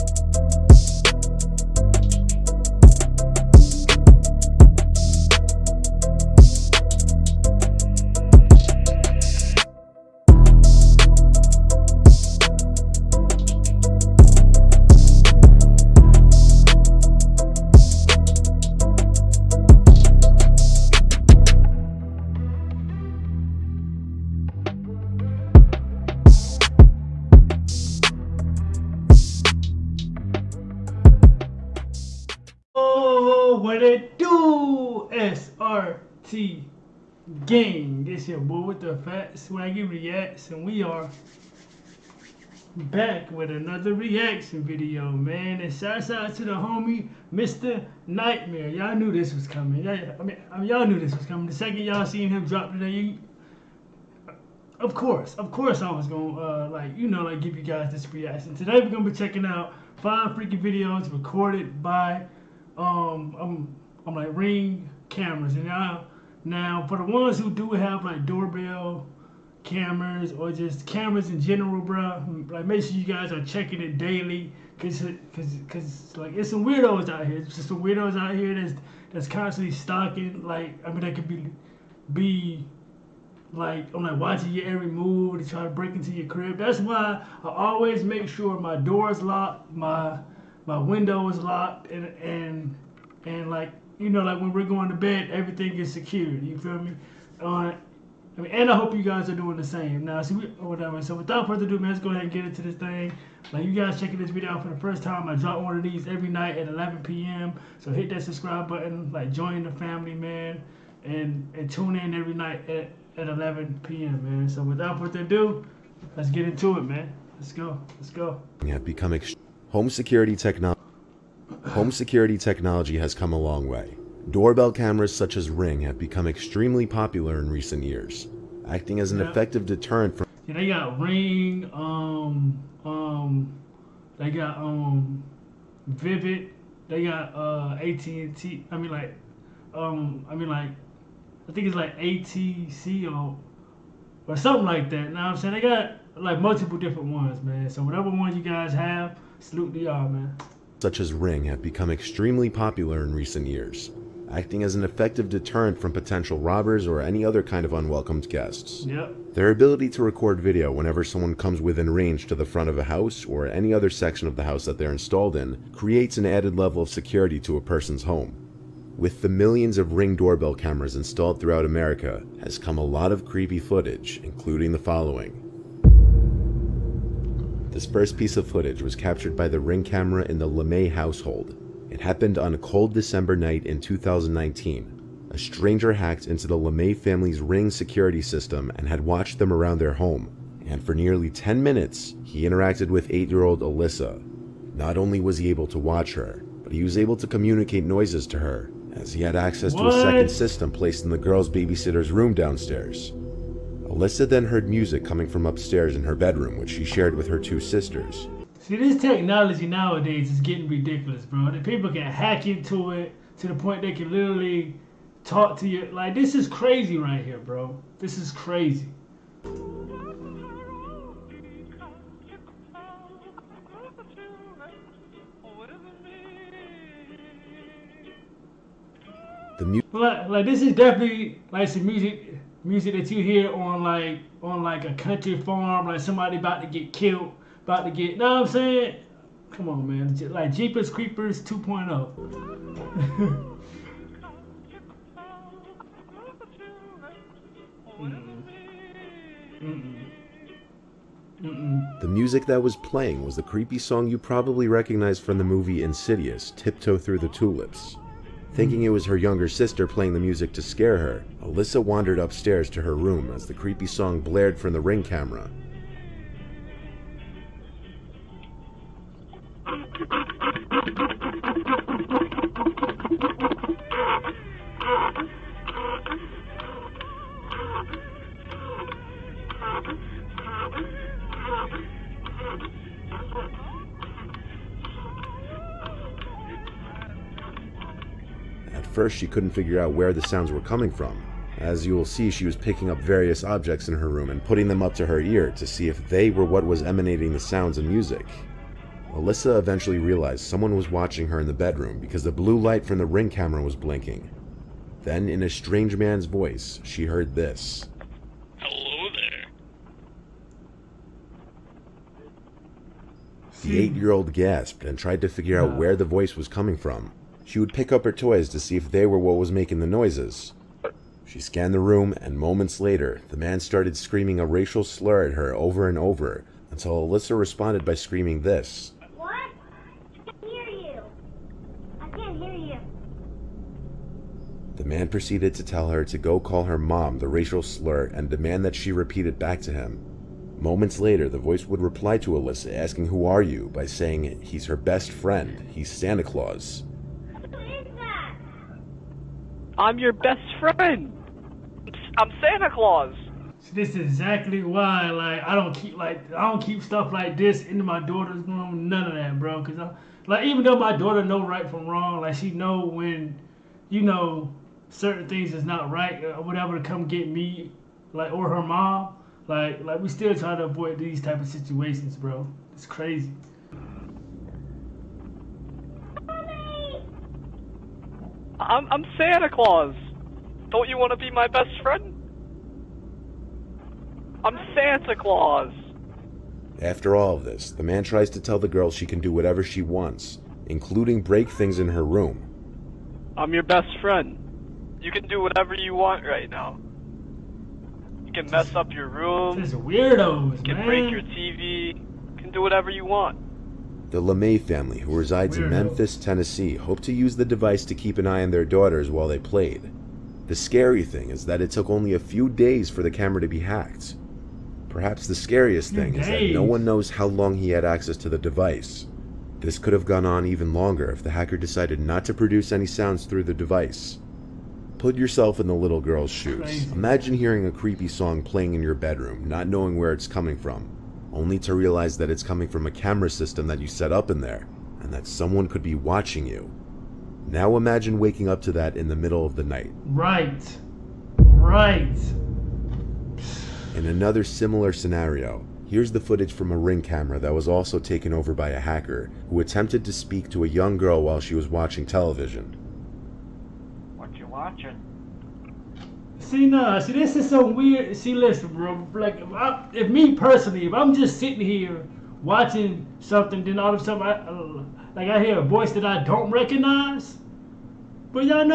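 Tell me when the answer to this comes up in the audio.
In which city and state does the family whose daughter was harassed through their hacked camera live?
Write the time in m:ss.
6:45.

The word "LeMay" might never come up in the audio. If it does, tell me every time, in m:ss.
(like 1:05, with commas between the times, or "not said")
3:00, 3:06, 6:44.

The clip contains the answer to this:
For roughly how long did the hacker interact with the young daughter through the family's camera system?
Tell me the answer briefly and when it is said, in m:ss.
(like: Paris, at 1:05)
nearly 10 minutes, at 3:10.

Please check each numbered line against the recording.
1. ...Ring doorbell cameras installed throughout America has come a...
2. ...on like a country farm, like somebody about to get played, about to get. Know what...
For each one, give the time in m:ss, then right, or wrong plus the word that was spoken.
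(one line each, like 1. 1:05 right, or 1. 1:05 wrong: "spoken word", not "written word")
1. 2:49 right
2. 3:54 wrong: "killed", not "played".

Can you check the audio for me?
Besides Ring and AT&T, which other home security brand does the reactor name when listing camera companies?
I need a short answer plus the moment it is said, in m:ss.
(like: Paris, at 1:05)
Vivint, at 2:15.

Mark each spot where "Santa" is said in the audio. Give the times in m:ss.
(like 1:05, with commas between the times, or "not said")
5:45, 5:52, 6:19, 6:24.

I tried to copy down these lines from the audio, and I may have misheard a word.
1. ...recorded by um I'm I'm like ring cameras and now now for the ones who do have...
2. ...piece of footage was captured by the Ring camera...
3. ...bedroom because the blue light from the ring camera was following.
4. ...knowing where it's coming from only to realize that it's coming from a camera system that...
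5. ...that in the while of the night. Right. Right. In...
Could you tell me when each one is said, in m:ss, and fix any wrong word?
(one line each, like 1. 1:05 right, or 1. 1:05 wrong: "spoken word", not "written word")
1. 1:01 right
2. 2:58 right
3. 5:01 wrong: "blinking", not "following"
4. 7:09 right
5. 7:18 wrong: "middle", not "while".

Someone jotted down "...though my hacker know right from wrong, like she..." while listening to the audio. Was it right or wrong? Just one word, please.
wrong.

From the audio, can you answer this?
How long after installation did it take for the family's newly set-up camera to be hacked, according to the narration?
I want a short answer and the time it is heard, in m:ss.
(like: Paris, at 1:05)
a few days, at 6:52.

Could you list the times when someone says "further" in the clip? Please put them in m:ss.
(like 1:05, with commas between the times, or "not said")
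1:41, 1:54.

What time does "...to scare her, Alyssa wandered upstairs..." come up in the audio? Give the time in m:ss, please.
4:20.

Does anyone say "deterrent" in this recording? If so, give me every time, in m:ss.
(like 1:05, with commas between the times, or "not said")
2:09, 2:35.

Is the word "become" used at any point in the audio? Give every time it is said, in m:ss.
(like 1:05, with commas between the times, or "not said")
1:58, 2:05, 2:31.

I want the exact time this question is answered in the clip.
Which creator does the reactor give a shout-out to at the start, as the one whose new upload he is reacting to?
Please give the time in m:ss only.
0:47.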